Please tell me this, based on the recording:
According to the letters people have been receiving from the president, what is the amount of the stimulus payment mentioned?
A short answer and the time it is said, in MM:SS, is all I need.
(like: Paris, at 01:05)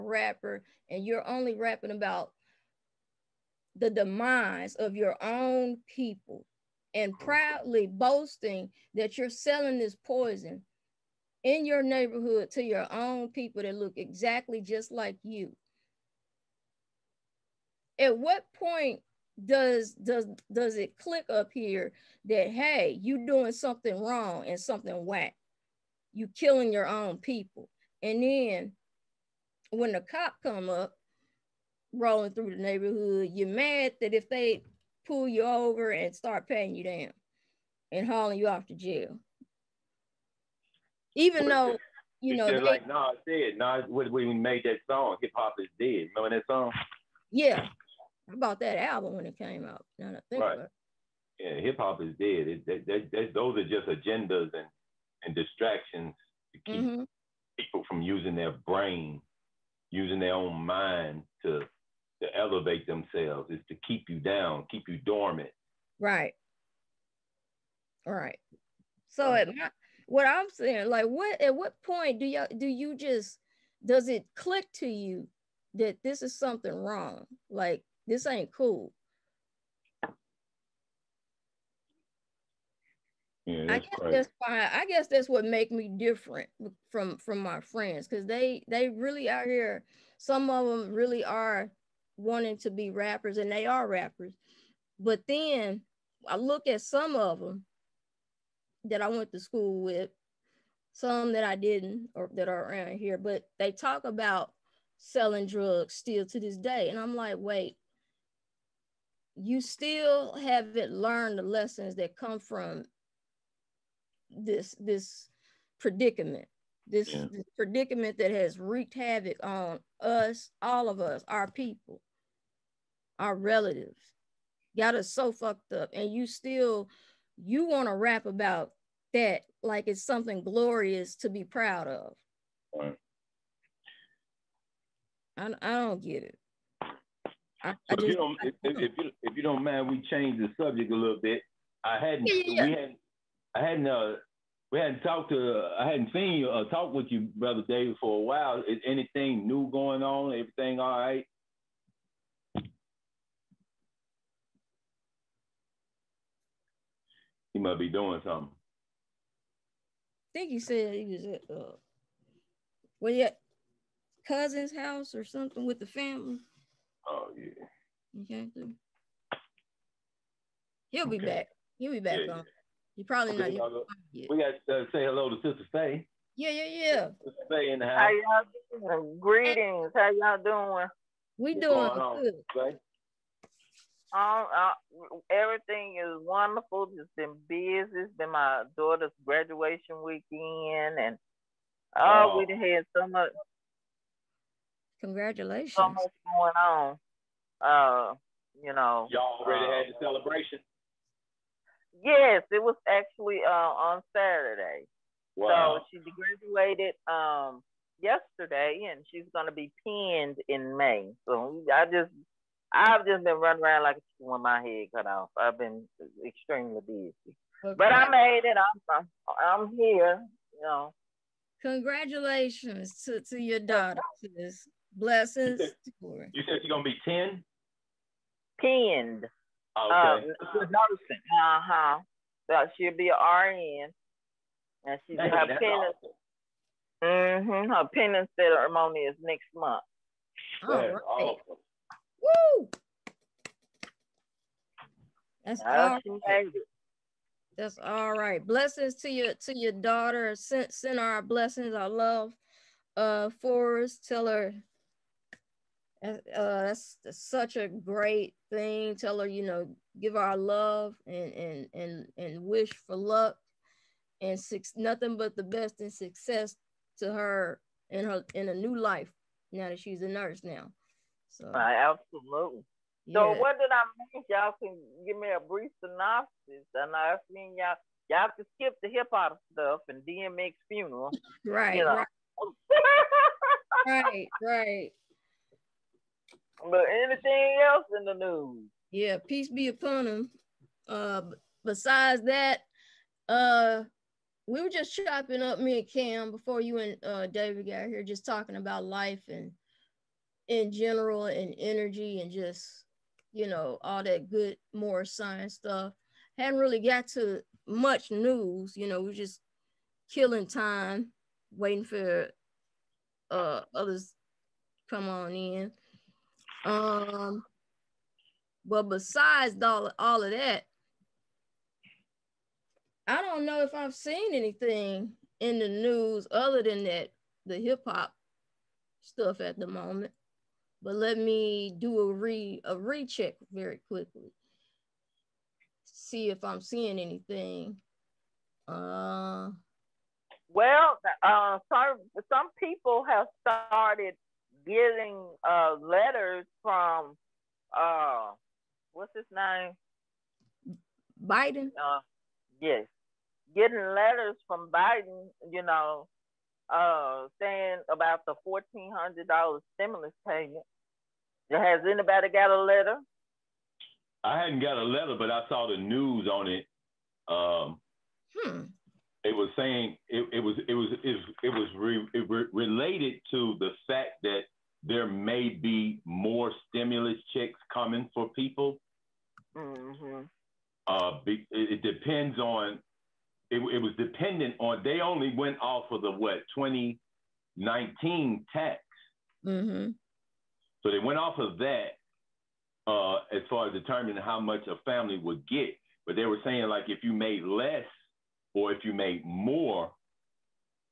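$1,400, at 05:58.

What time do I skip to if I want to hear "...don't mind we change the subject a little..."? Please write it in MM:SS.
02:19.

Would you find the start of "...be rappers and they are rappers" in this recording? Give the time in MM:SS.
01:32.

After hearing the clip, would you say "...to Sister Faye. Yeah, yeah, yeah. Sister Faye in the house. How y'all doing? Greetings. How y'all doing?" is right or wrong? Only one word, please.
right.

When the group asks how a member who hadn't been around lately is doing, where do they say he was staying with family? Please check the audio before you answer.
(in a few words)
cousin's house.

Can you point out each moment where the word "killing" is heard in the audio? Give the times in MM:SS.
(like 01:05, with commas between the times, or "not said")
00:26, 05:10.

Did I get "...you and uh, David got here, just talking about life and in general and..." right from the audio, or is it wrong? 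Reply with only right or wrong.
right.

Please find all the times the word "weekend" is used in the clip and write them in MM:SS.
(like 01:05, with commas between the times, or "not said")
03:10.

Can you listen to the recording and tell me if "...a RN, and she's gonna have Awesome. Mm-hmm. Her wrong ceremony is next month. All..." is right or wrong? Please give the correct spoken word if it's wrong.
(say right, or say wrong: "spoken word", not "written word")
wrong: "pinning", not "wrong".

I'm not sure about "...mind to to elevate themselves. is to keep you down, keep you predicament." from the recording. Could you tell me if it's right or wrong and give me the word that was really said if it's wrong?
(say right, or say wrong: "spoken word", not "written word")
wrong: "dormant", not "predicament".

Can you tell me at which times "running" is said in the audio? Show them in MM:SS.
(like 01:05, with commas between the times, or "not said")
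03:33.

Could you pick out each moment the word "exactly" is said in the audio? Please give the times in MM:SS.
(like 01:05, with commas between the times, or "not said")
00:13, 02:48.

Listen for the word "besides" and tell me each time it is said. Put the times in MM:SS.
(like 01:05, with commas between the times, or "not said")
04:51, 05:18.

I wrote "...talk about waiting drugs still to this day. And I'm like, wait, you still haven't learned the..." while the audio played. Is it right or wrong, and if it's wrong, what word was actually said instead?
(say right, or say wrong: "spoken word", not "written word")
wrong: "selling", not "waiting".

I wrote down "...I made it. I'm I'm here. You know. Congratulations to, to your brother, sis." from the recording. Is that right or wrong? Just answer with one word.
wrong.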